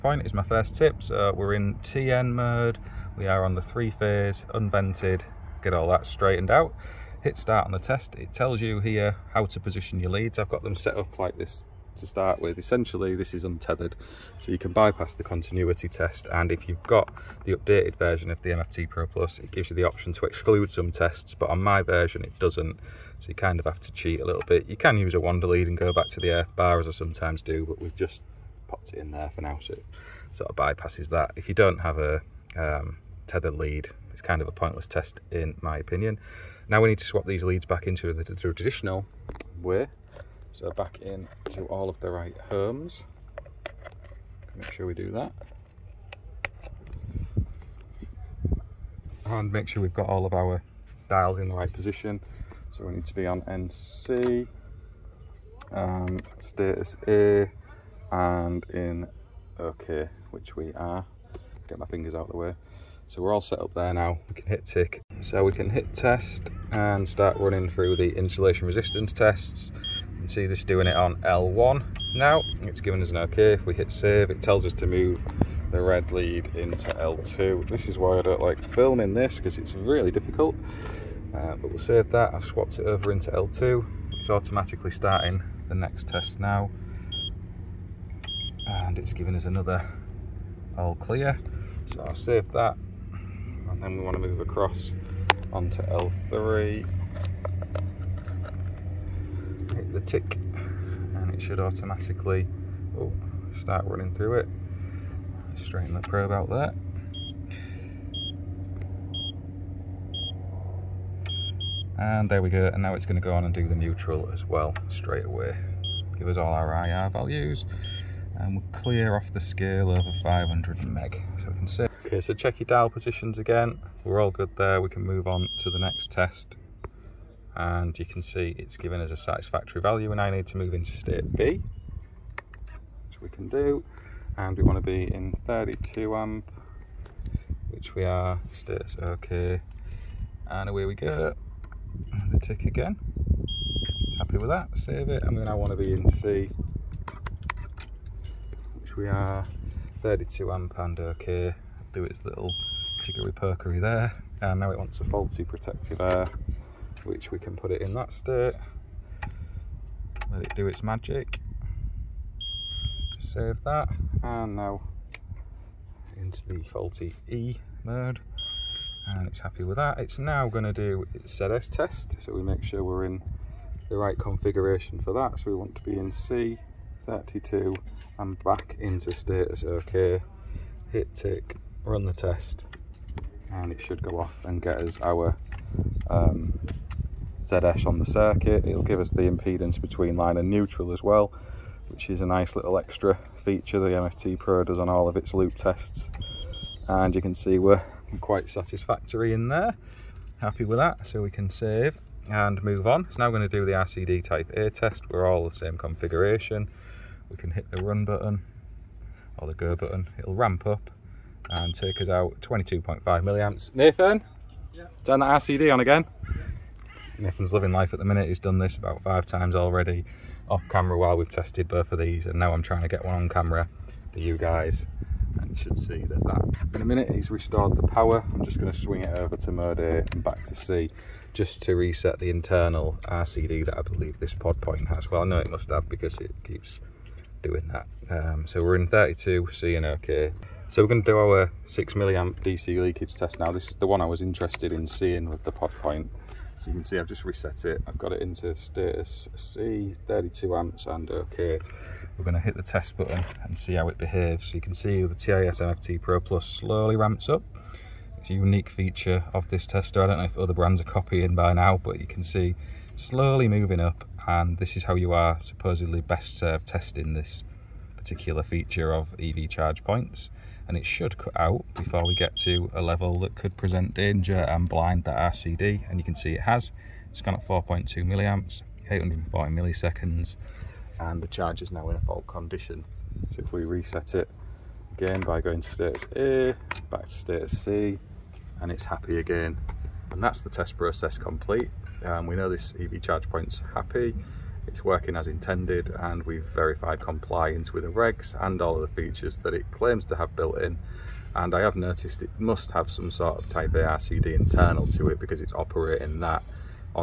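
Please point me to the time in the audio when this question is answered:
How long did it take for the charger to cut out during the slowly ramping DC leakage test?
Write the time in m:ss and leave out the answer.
4:38.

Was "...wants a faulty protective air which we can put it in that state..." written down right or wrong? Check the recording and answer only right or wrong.
right.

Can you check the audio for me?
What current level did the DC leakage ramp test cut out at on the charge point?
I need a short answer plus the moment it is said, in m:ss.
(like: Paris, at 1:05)
4.2 milliamps, at 4:37.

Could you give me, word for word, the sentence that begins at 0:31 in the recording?
If you don't have a um, tether lead, it's kind of a pointless test in my opinion.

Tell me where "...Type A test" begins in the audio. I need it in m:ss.
3:24.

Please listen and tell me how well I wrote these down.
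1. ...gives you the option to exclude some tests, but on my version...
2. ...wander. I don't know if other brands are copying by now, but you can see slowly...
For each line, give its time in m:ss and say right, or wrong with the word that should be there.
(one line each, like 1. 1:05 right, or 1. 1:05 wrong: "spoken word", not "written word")
1. 0:19 right
2. 4:19 wrong: "tester", not "wander".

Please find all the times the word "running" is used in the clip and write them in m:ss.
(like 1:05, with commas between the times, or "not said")
1:07, 1:43.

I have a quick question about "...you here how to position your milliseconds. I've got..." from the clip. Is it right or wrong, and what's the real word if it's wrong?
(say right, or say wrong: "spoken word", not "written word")
wrong: "leads", not "milliseconds".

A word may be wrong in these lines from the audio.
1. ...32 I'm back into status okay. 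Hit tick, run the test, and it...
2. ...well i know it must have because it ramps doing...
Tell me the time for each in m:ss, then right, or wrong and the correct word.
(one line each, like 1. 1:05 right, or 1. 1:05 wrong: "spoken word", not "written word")
1. 2:57 right
2. 3:55 wrong: "keeps", not "ramps".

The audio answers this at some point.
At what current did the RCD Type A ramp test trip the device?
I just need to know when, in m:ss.
3:32.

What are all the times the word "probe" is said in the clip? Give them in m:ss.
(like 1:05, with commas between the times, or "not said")
1:46.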